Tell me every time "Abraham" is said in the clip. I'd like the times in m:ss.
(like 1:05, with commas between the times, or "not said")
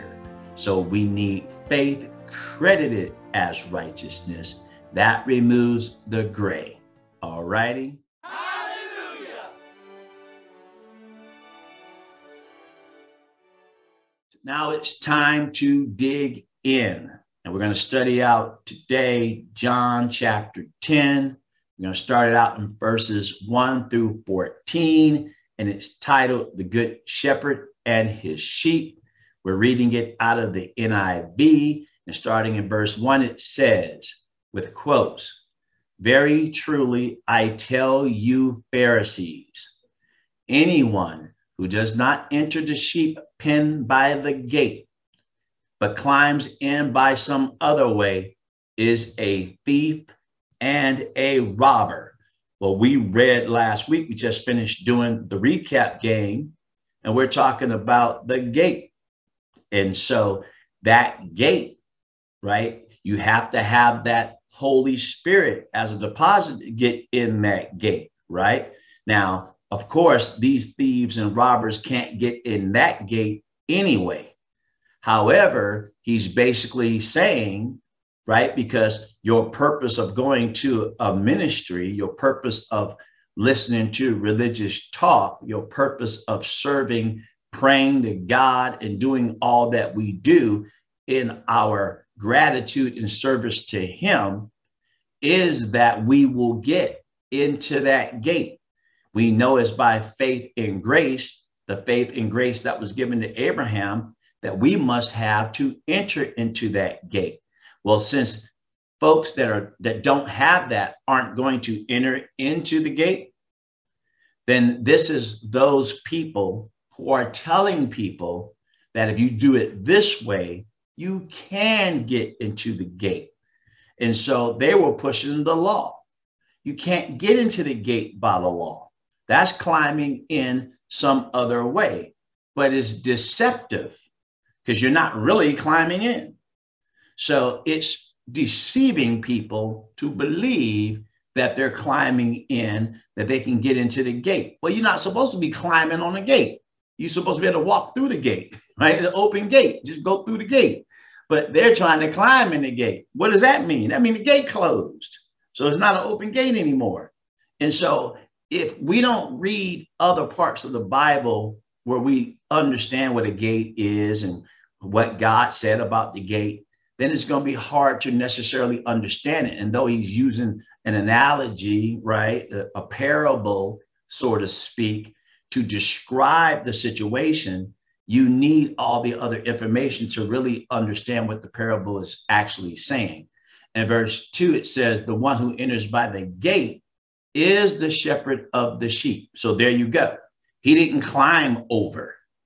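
1:43.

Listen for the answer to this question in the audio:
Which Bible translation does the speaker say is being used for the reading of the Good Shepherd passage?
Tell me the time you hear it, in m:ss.
0:30.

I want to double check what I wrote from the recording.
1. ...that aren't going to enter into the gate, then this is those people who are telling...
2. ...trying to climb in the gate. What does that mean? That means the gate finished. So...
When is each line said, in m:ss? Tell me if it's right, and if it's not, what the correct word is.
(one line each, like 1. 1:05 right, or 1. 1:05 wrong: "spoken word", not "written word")
1. 1:50 right
2. 2:31 wrong: "closed", not "finished".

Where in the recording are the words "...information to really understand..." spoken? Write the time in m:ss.
2:59.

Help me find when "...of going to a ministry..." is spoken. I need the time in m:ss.
1:19.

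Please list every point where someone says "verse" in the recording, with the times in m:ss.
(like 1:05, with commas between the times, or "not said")
0:22, 0:32, 3:03.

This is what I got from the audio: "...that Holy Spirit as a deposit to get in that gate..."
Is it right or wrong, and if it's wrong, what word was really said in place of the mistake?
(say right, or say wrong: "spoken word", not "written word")
right.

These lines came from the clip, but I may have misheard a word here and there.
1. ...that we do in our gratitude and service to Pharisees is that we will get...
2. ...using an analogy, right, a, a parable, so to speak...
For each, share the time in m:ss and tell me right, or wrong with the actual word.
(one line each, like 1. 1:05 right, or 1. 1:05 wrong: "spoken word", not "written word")
1. 1:29 wrong: "Him", not "Pharisees"
2. 2:50 right.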